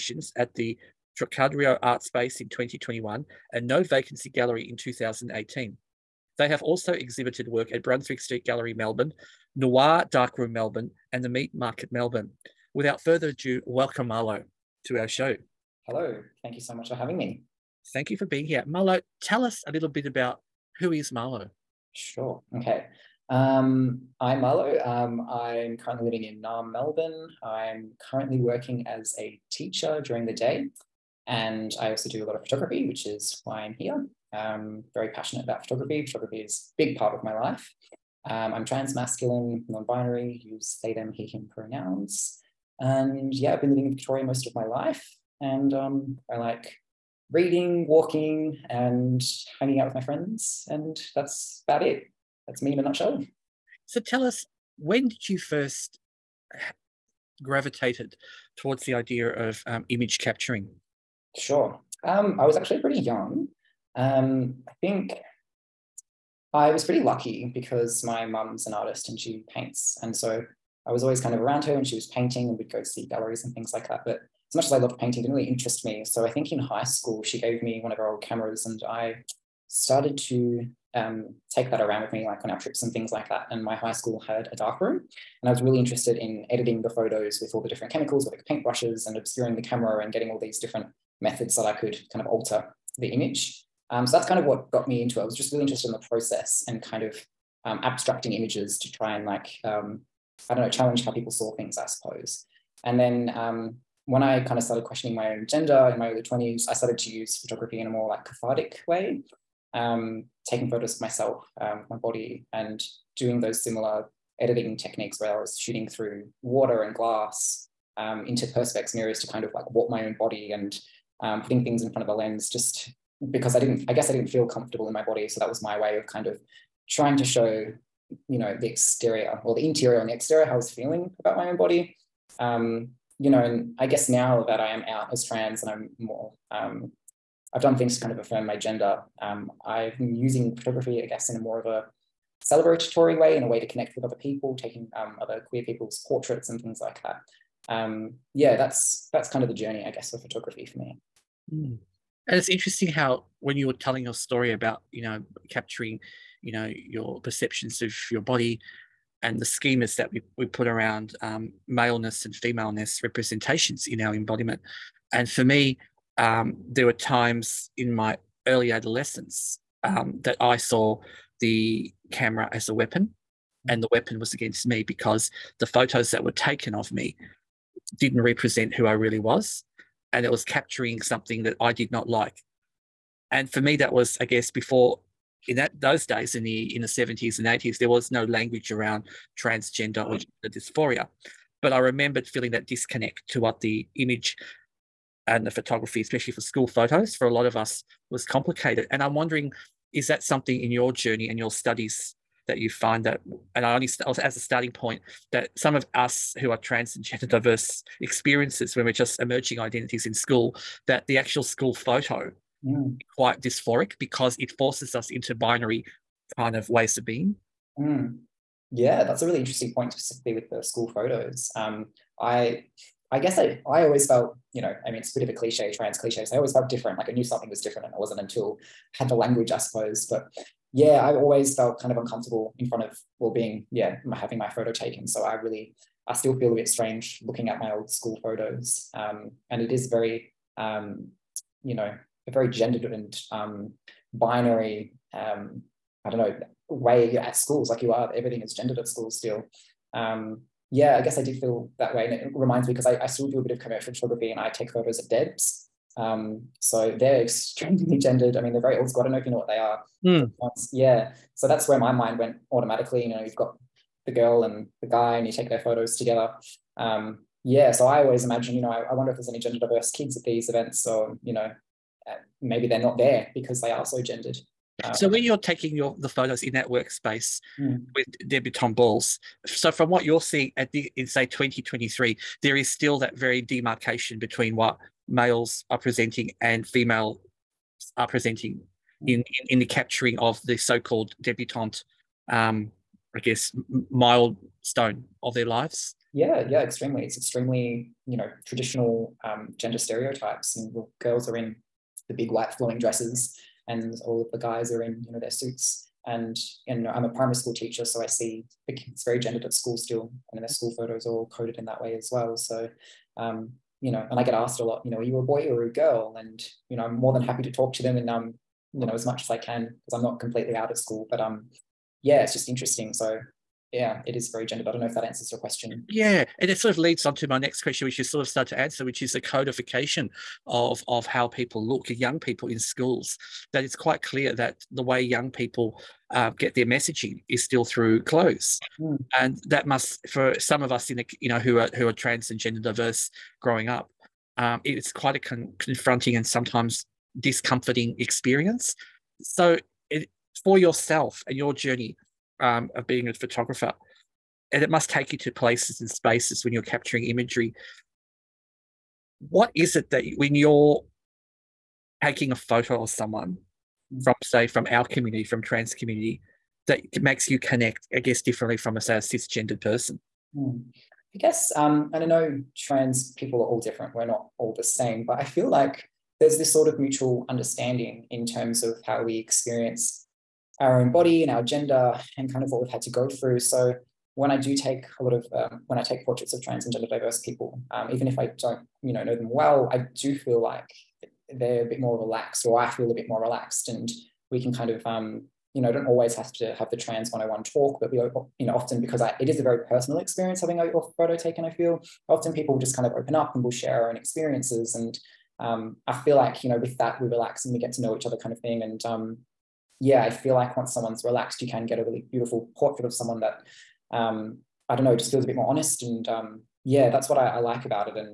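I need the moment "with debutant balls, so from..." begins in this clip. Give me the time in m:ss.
4:37.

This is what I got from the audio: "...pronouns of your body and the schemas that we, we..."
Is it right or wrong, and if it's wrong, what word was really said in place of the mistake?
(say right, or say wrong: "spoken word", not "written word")
wrong: "perceptions", not "pronouns".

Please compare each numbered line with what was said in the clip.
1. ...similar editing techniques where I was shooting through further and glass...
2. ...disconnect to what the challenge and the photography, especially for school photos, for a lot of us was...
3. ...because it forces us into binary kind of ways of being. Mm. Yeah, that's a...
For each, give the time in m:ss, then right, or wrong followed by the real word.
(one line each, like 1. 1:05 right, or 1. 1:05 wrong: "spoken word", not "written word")
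1. 1:53 wrong: "water", not "further"
2. 3:12 wrong: "image", not "challenge"
3. 3:34 right.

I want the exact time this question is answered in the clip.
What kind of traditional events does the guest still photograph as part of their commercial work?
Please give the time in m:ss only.
4:15.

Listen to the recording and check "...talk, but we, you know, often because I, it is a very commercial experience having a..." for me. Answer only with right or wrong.
wrong.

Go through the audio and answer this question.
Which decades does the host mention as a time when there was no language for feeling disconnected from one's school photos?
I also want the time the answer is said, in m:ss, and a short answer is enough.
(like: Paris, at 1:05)
The 70s and 80s, at 3:06.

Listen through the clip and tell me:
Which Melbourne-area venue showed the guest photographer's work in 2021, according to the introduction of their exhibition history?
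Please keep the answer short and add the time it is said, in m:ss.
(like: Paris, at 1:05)
Trocadero Art Space, at 0:01.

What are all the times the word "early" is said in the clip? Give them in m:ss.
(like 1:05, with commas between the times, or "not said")
1:46, 2:48.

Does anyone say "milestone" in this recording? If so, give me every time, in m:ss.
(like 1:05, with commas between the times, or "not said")
4:53.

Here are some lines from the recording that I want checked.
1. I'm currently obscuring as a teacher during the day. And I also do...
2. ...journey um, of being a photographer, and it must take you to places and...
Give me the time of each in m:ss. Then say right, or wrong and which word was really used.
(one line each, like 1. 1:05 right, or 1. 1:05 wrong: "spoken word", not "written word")
1. 0:27 wrong: "working", not "obscuring"
2. 5:51 right.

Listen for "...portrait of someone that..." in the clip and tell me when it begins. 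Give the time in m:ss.
6:52.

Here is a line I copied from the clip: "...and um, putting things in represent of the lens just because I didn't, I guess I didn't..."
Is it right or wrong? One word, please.
wrong.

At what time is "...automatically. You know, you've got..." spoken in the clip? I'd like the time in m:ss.
4:22.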